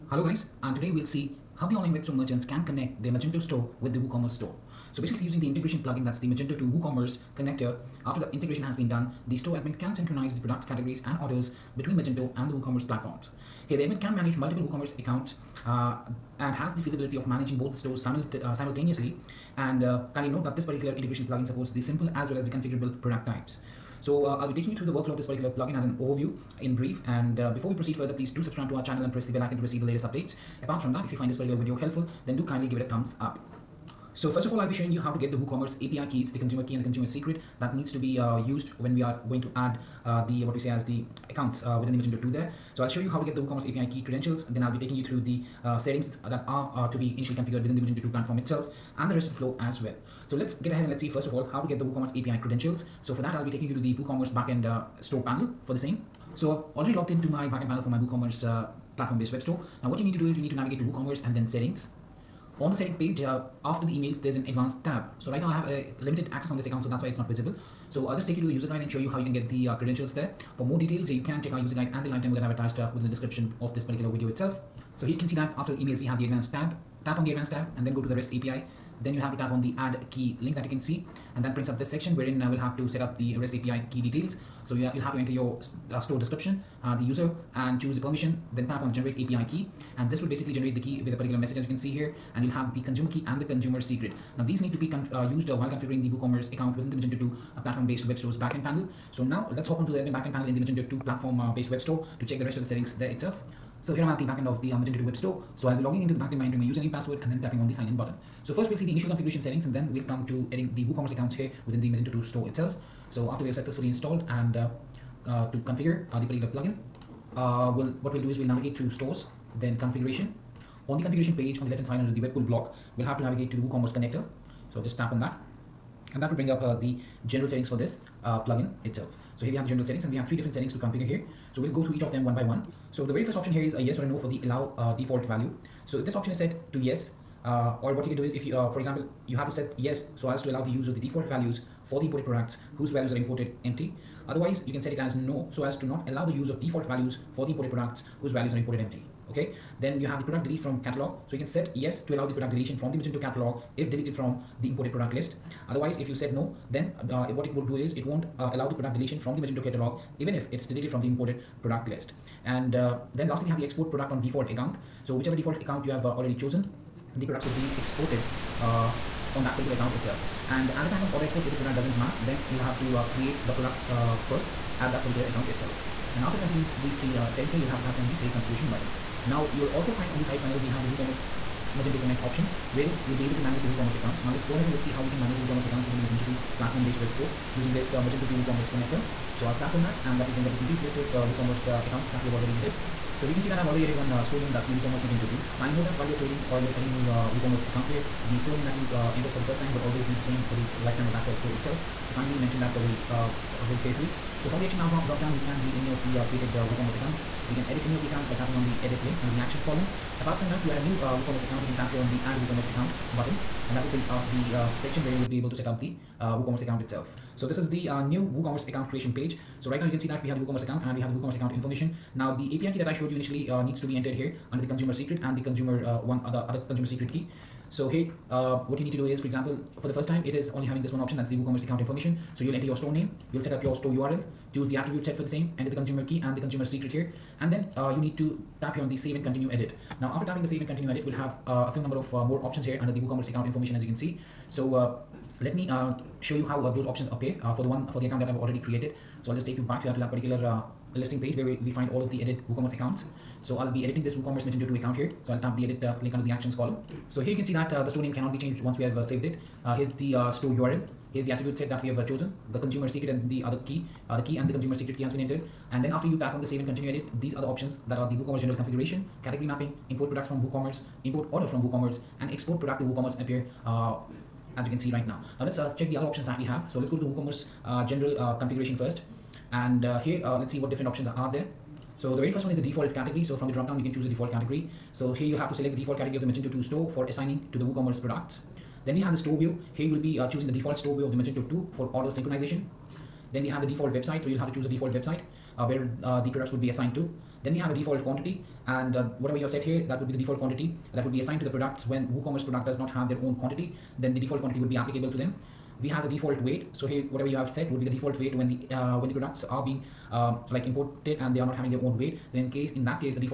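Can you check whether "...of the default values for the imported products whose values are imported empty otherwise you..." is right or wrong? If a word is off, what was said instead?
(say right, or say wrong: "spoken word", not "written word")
right.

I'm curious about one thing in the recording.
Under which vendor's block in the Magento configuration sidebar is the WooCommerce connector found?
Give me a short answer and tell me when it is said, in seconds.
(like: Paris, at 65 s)
Webkul, at 122 s.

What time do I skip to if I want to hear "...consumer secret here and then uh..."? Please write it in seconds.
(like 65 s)
236 s.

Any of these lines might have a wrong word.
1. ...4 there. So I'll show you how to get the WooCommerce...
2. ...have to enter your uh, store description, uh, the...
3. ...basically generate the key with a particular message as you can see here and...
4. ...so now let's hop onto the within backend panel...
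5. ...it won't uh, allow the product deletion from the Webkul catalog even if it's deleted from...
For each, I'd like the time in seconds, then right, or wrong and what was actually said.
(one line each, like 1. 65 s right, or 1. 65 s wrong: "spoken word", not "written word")
1. 42 s wrong: "2", not "4"
2. 85 s right
3. 90 s right
4. 99 s wrong: "admin", not "within"
5. 157 s wrong: "Magento", not "Webkul".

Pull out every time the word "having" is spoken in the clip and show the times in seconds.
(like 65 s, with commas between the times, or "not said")
230 s, 311 s.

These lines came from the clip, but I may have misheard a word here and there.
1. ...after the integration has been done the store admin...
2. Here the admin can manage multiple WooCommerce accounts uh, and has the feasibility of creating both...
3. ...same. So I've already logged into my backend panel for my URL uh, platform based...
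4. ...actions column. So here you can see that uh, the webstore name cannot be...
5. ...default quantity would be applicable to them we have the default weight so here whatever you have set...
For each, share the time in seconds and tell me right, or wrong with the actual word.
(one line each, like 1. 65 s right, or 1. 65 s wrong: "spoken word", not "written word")
1. 8 s right
2. 13 s wrong: "managing", not "creating"
3. 55 s wrong: "WooCommerce", not "URL"
4. 256 s wrong: "store", not "webstore"
5. 304 s right.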